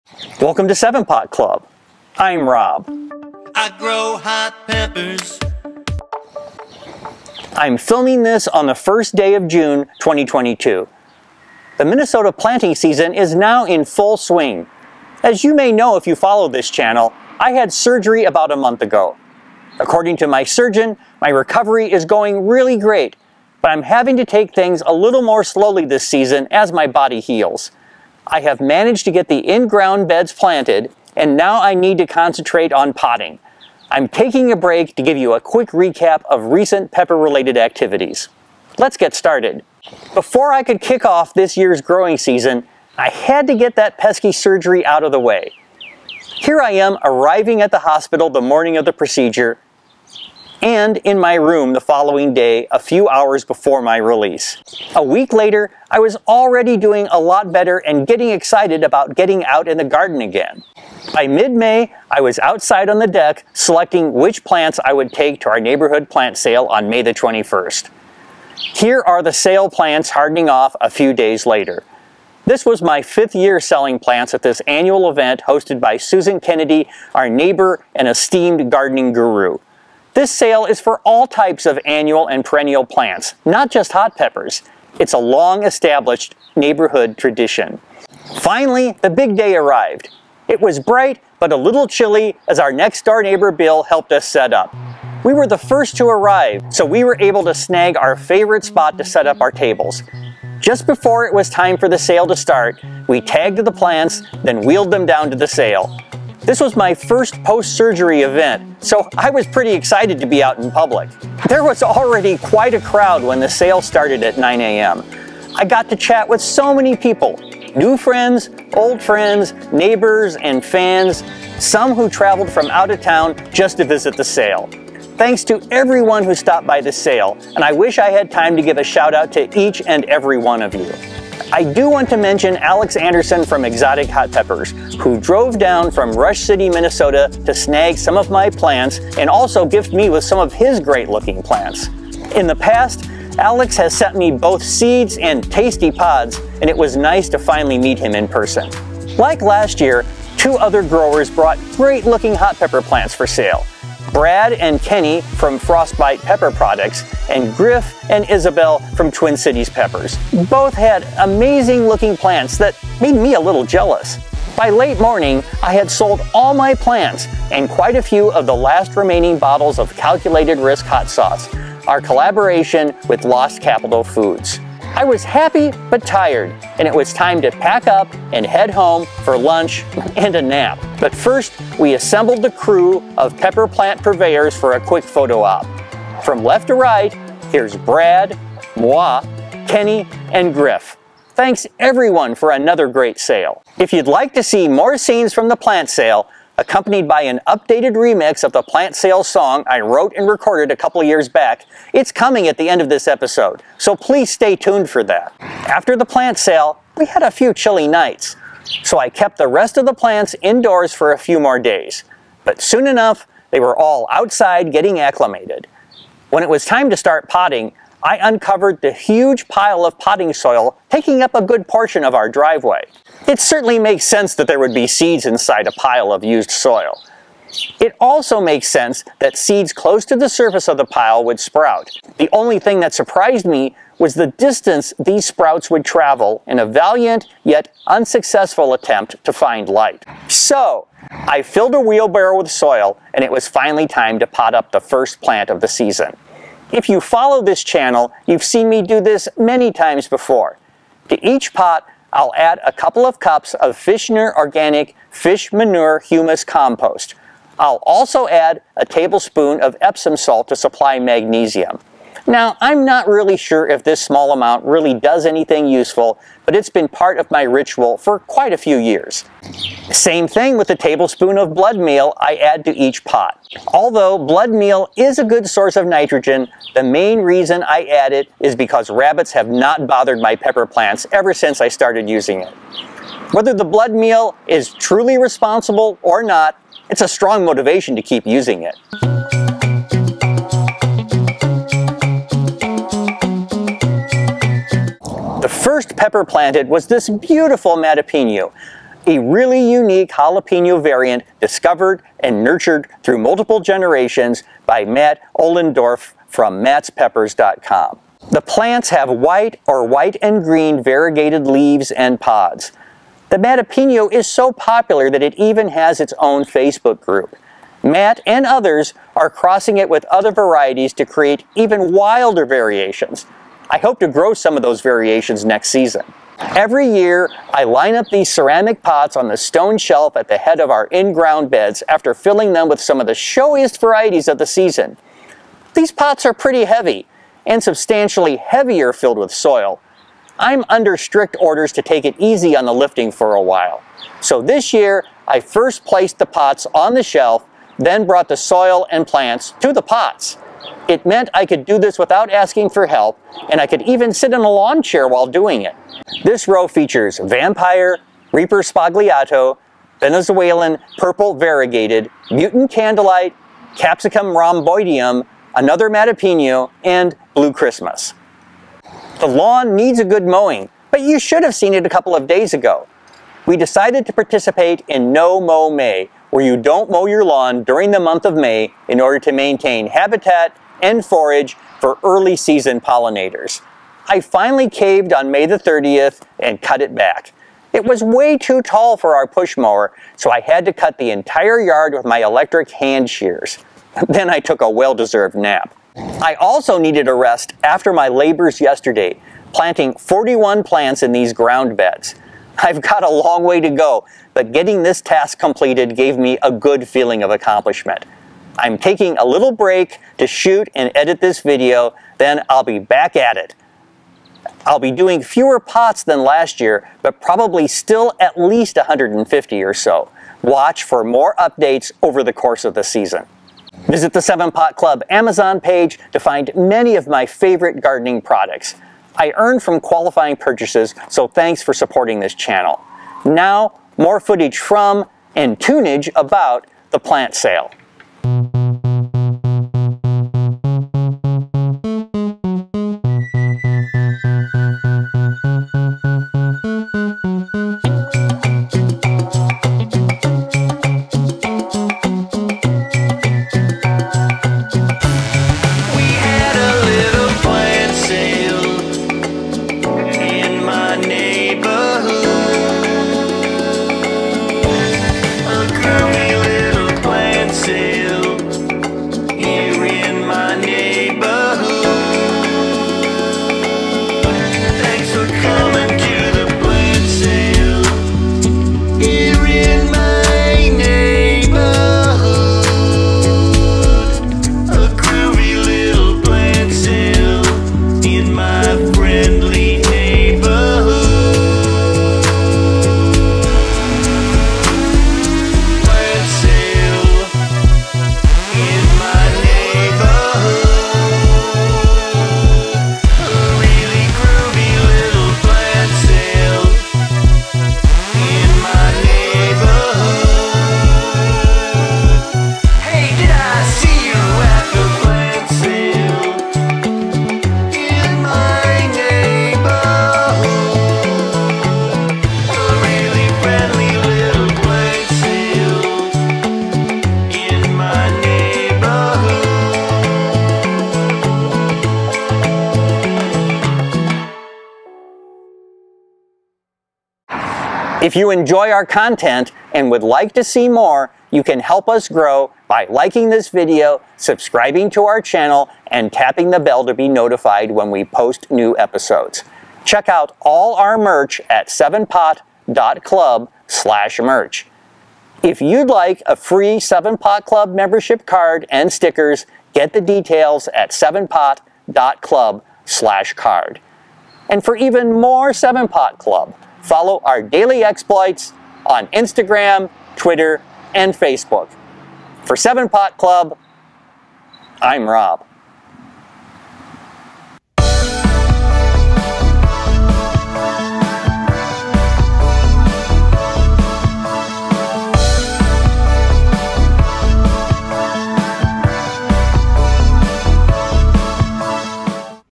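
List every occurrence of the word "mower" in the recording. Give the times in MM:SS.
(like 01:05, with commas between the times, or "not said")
06:29.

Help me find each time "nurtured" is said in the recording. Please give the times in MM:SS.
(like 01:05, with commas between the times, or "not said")
05:02.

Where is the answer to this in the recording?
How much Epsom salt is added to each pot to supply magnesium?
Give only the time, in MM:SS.
04:18.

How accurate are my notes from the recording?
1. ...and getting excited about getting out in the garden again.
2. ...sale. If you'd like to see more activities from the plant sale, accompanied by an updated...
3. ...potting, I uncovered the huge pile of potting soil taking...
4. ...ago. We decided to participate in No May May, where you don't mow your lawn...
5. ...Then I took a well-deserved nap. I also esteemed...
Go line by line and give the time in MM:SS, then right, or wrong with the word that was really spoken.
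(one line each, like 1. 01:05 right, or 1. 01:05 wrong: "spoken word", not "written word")
1. 00:57 right
2. 03:13 wrong: "scenes", not "activities"
3. 03:37 right
4. 06:12 wrong: "Mow", not "May"
5. 06:34 wrong: "needed", not "esteemed".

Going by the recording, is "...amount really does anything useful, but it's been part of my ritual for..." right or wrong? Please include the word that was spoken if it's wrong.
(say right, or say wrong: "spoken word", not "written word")
right.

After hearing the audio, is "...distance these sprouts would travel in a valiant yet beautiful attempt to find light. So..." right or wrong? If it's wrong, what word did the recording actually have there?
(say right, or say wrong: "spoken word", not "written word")
wrong: "unsuccessful", not "beautiful".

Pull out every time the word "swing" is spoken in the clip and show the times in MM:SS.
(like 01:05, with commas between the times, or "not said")
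00:14.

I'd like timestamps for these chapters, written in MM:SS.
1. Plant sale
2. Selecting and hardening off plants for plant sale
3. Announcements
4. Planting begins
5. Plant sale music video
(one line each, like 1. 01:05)
1. 01:28
2. 01:04
3. 08:58
4. 03:25
5. 07:18.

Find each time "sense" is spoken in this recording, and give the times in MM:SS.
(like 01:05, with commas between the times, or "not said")
03:44, 03:48.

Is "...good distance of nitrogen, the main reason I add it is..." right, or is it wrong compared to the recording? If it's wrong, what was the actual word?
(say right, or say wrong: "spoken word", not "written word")
wrong: "source", not "distance".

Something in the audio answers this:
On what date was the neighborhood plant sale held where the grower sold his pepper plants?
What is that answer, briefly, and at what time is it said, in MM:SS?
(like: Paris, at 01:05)
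May 21st, at 01:06.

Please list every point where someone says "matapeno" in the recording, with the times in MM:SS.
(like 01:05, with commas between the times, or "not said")
04:57, 05:13, 06:05.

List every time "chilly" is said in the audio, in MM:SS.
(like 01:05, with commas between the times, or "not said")
01:31, 03:27.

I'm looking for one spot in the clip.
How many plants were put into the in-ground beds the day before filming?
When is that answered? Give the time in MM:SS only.
06:39.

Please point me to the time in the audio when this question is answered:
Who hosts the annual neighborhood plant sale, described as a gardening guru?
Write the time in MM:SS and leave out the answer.
01:15.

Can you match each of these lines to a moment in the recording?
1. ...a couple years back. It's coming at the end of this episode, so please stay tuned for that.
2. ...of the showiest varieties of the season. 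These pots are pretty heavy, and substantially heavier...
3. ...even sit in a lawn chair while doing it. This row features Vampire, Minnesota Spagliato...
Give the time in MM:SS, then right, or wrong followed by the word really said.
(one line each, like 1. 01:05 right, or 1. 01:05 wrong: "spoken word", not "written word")
1. 03:20 right
2. 05:32 right
3. 05:53 wrong: "Reaper", not "Minnesota".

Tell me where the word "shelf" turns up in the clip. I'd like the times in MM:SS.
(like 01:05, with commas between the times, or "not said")
05:29, 05:47.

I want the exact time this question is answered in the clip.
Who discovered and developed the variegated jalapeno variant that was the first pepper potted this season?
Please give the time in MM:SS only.
05:04.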